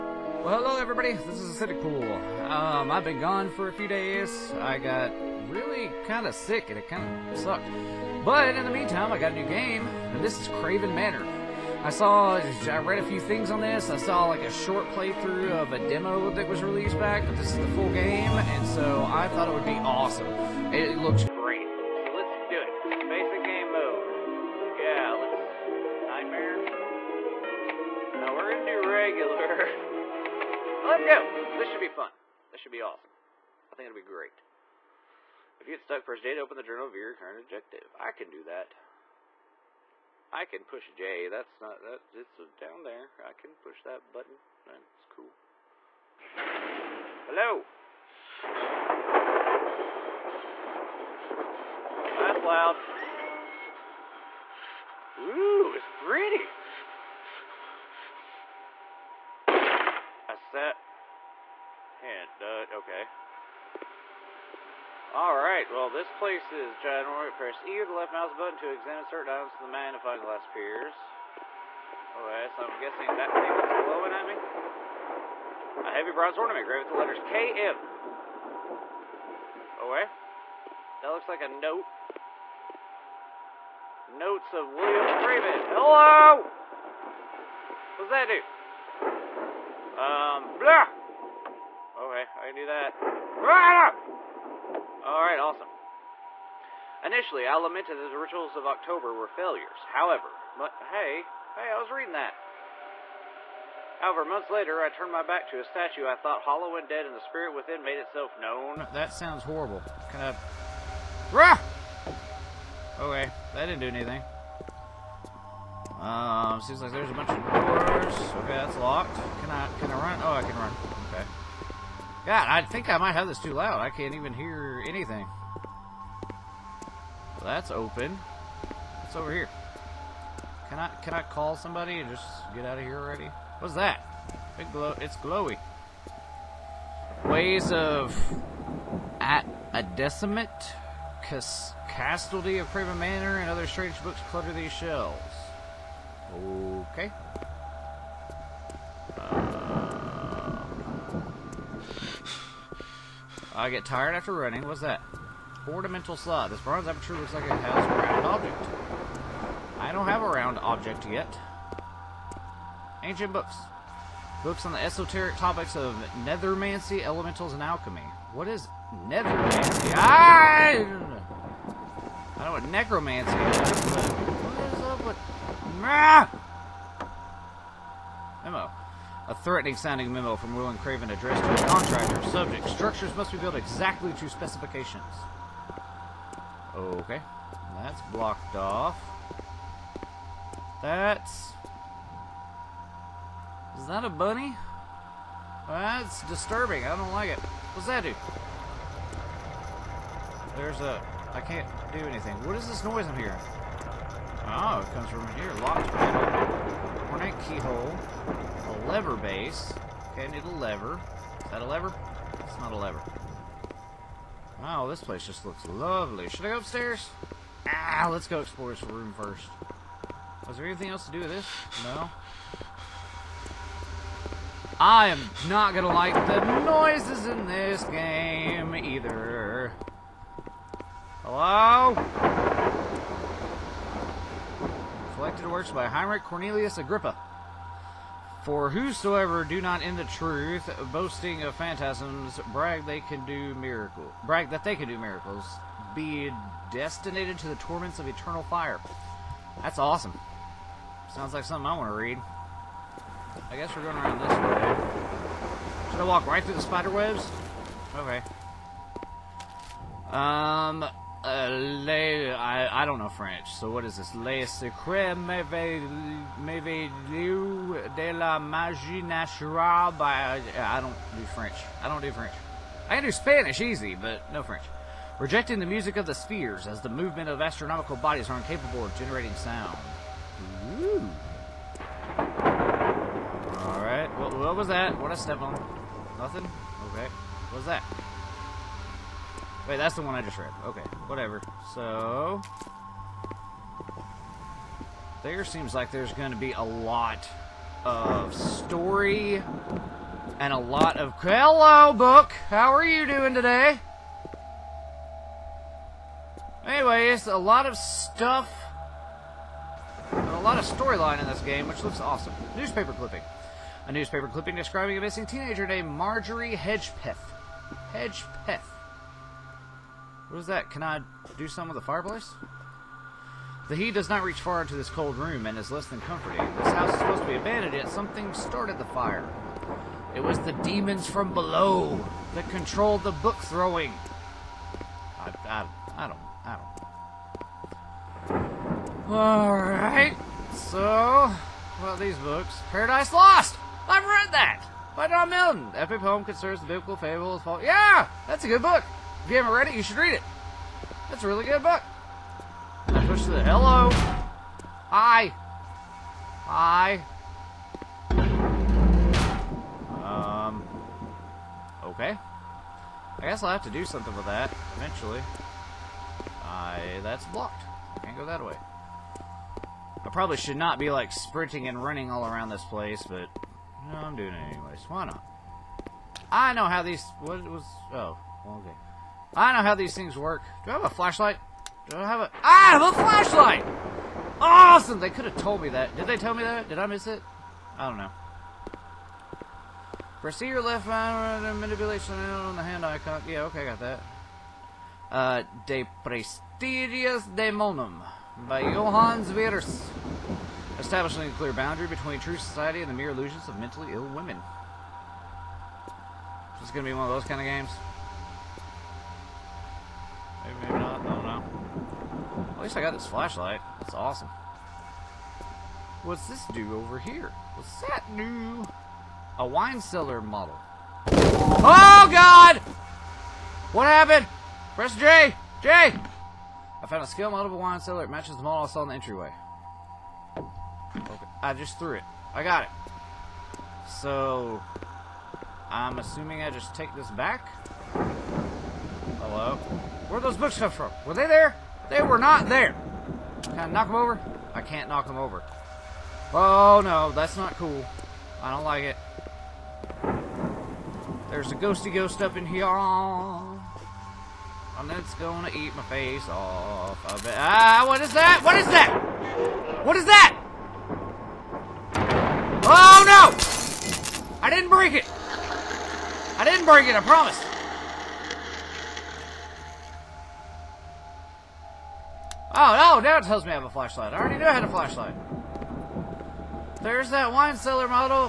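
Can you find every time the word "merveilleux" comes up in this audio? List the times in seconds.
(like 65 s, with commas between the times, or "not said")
265 s.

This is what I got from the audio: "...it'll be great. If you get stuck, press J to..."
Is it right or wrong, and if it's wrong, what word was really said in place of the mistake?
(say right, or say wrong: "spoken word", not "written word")
right.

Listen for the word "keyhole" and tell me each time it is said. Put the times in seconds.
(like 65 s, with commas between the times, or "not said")
207 s.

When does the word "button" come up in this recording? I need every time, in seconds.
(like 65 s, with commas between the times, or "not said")
44 s, 68 s.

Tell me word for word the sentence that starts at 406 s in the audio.
This is going to be one of those kind of games.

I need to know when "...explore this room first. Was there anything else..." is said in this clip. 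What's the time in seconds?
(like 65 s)
218 s.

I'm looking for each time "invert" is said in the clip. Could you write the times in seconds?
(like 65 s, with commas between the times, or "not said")
not said.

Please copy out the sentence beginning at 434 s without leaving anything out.
So, I'm assuming I just take this back?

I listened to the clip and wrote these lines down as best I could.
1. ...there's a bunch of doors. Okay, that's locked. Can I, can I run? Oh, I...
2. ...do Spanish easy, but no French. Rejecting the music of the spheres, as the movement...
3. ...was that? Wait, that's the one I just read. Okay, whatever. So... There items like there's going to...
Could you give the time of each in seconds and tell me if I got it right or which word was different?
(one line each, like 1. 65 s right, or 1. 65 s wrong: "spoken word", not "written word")
1. 116 s right
2. 273 s right
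3. 287 s wrong: "seems", not "items".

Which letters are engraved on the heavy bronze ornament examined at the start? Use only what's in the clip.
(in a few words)
KM.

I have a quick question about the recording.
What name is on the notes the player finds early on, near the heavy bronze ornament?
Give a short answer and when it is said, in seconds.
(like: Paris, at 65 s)
William Freeman, at 84 s.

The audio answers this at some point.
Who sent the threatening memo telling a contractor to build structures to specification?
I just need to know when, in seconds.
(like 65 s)
180 s.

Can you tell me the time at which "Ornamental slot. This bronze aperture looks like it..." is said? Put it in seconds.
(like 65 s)
155 s.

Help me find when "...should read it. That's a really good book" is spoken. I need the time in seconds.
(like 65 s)
349 s.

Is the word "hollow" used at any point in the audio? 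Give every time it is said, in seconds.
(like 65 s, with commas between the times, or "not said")
106 s.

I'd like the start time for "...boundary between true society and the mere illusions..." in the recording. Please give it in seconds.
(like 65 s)
401 s.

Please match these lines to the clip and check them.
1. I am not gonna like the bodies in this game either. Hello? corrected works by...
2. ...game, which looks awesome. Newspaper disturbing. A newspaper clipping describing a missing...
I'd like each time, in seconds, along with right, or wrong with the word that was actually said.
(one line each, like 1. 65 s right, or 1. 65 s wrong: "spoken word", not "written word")
1. 224 s wrong: "noises", not "bodies"
2. 311 s wrong: "clipping", not "disturbing".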